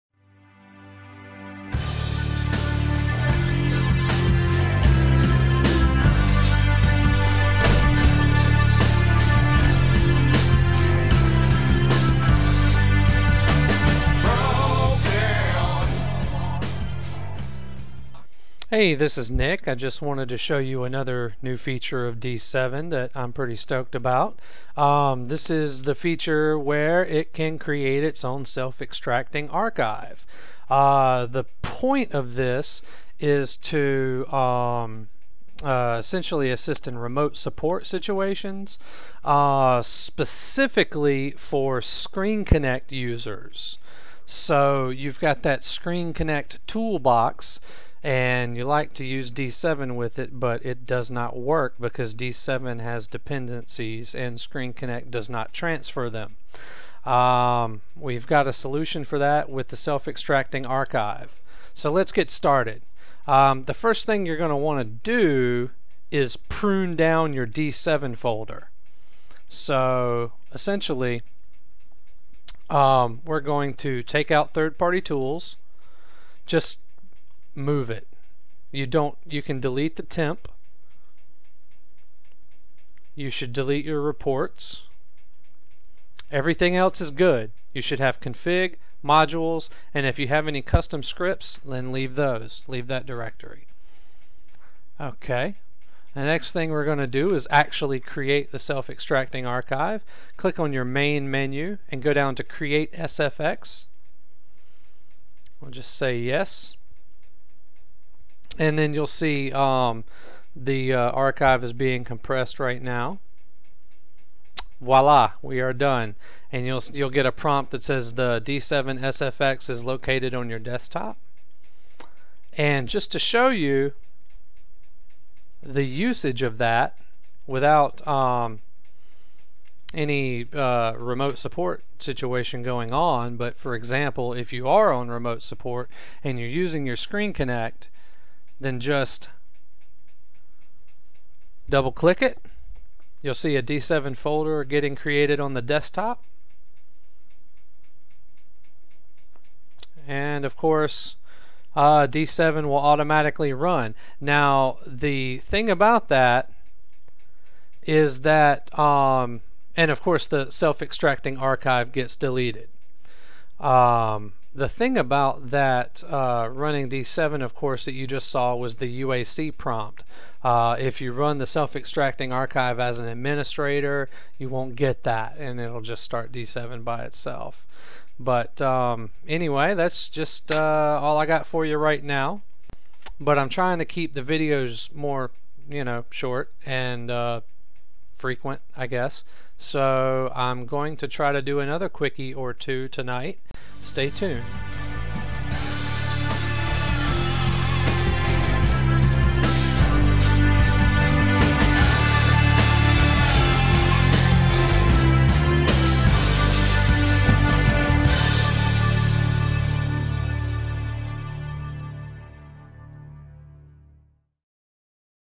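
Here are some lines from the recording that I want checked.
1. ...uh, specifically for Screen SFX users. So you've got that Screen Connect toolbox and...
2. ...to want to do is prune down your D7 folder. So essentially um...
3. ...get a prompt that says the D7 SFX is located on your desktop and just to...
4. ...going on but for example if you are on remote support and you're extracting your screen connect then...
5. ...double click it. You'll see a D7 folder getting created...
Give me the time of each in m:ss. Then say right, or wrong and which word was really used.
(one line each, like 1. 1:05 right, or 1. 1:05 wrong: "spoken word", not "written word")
1. 0:39 wrong: "Connect", not "SFX"
2. 1:04 right
3. 1:57 right
4. 2:12 wrong: "using", not "extracting"
5. 2:21 right.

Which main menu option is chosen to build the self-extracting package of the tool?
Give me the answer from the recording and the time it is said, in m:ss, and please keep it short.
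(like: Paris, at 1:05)
Create SFX, at 1:42.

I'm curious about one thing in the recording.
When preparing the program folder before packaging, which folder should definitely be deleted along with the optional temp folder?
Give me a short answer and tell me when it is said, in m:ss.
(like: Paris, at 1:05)
reports, at 1:23.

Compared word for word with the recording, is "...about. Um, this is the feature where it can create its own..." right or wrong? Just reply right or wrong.
right.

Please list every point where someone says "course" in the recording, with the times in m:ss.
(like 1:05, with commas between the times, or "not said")
2:30, 2:40, 2:47.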